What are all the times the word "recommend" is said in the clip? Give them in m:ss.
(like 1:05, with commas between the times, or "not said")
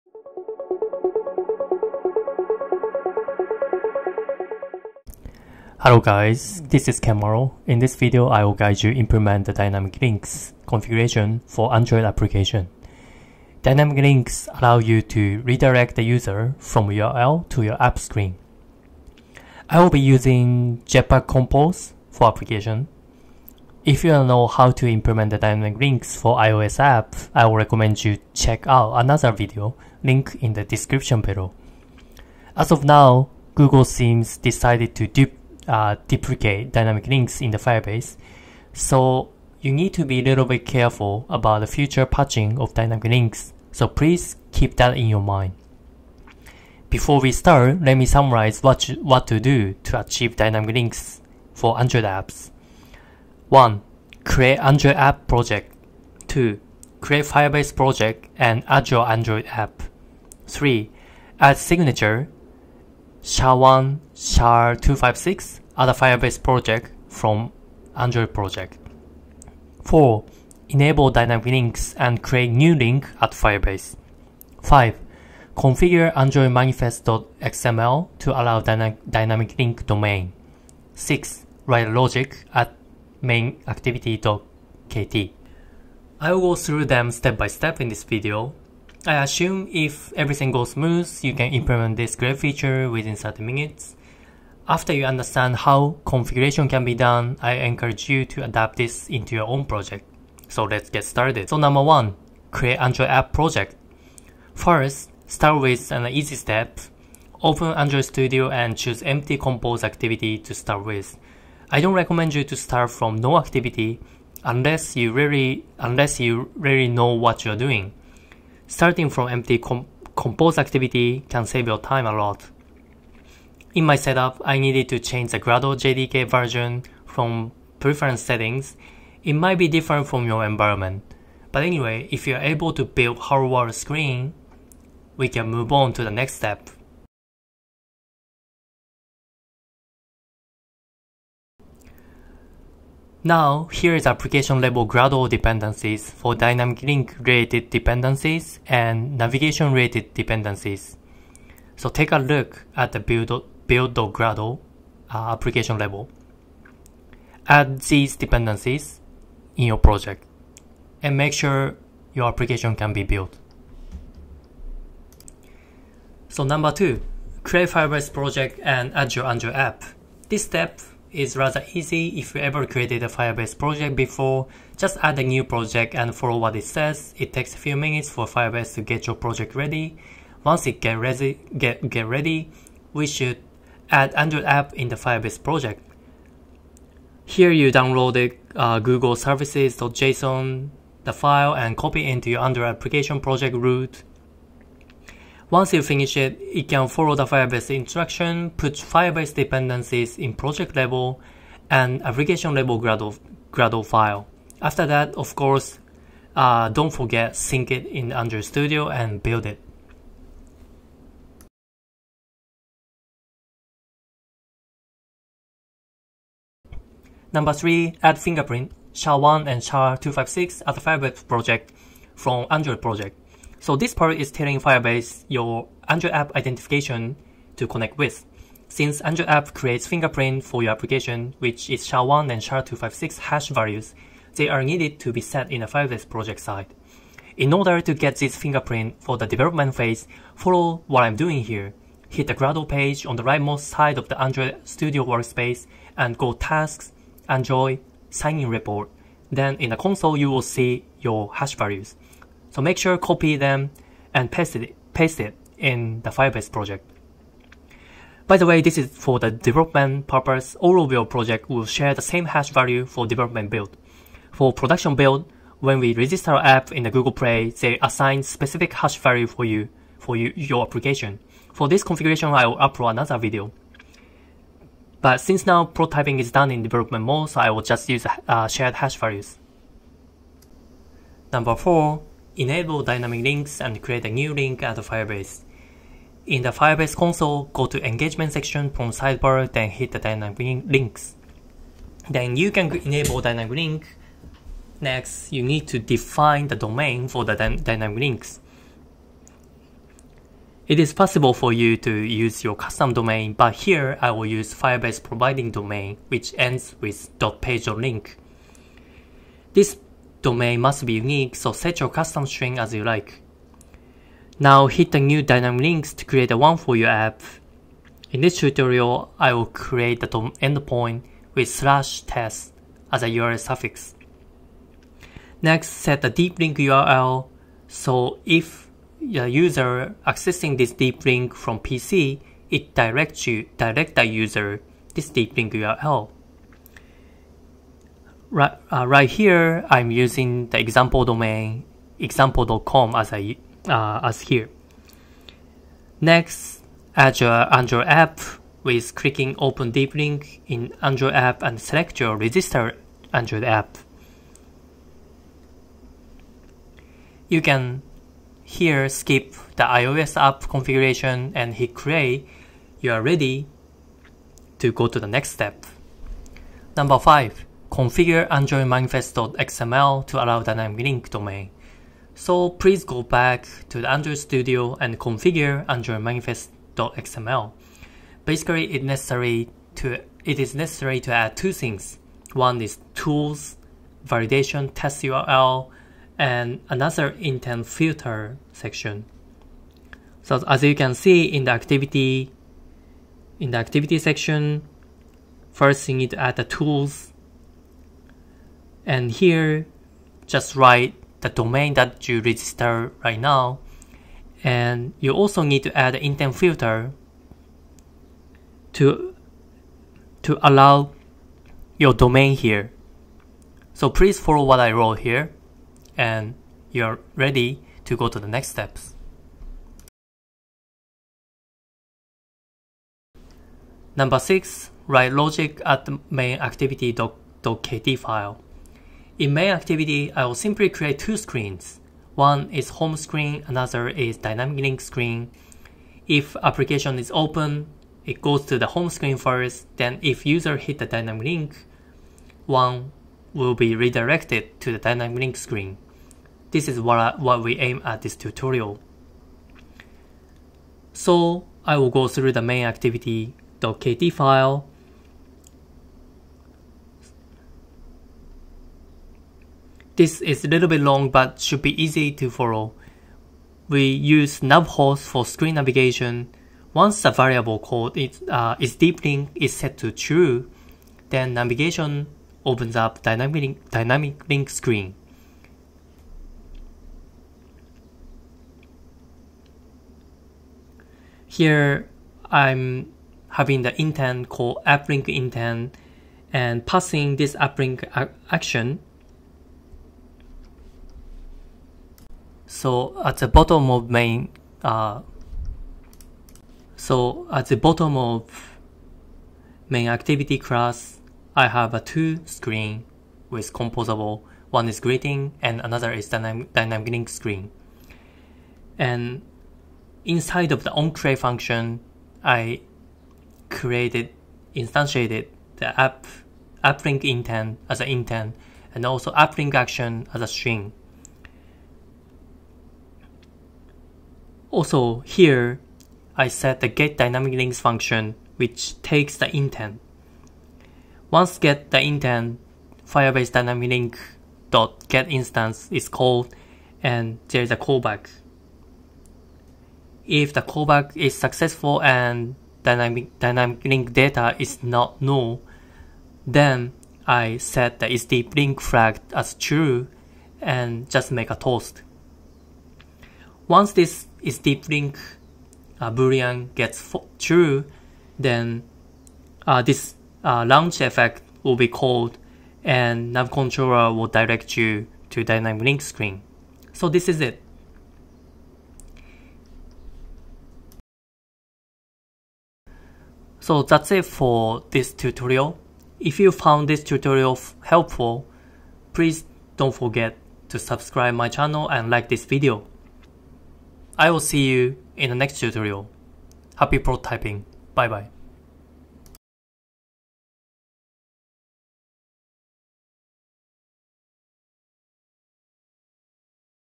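0:27, 1:51.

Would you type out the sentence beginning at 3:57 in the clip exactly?
In order to get this fingerprint for the development phase, follow what I'm doing here.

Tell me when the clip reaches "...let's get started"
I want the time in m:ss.
1:40.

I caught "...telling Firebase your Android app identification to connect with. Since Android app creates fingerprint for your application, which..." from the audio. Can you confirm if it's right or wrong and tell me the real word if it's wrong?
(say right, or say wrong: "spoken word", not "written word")
right.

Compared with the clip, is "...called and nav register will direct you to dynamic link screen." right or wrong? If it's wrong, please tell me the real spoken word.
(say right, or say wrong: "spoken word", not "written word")
wrong: "controller", not "register".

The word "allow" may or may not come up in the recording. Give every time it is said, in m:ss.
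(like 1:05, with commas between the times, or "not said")
0:14, 1:18, 6:10, 6:50.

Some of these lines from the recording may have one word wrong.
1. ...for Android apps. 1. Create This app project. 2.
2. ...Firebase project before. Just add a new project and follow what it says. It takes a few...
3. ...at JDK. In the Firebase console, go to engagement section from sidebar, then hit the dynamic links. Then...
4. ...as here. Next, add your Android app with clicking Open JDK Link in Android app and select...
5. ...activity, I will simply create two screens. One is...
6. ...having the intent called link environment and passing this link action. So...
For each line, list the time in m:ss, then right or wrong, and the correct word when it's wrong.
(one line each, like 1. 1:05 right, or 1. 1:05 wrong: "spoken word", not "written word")
1. 0:51 wrong: "Android", not "This"
2. 2:53 right
3. 4:44 wrong: "Firebase", not "JDK"
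4. 5:44 wrong: "Deep", not "JDK"
5. 7:09 right
6. 8:03 wrong: "intent", not "environment".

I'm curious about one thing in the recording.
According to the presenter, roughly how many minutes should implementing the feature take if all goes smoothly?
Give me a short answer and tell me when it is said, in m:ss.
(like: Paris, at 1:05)
30 minutes, at 1:33.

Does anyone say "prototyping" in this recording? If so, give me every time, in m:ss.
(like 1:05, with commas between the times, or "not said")
4:35, 9:46.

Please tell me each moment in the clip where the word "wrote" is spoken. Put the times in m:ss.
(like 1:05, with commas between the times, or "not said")
6:54.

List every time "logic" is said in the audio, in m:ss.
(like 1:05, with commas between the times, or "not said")
1:21, 7:05.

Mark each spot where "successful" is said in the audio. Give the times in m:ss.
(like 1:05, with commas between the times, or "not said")
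9:01.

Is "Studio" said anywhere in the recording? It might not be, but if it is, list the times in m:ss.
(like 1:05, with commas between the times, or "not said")
1:48, 3:28, 4:04, 6:14.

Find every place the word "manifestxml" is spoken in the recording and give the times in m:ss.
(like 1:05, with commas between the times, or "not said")
1:16, 6:08, 6:16.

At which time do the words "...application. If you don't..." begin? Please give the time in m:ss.
0:22.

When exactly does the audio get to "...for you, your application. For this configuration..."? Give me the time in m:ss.
4:29.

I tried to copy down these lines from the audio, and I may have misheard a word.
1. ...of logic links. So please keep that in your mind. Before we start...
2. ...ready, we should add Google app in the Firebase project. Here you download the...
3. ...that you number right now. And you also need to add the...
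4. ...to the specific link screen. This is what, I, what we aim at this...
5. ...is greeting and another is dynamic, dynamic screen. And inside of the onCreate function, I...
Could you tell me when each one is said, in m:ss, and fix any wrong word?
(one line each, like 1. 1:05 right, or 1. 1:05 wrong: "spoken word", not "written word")
1. 0:42 wrong: "dynamic", not "logic"
2. 3:02 wrong: "Android", not "Google"
3. 6:41 wrong: "register", not "number"
4. 7:24 wrong: "dynamic", not "specific"
5. 8:24 right.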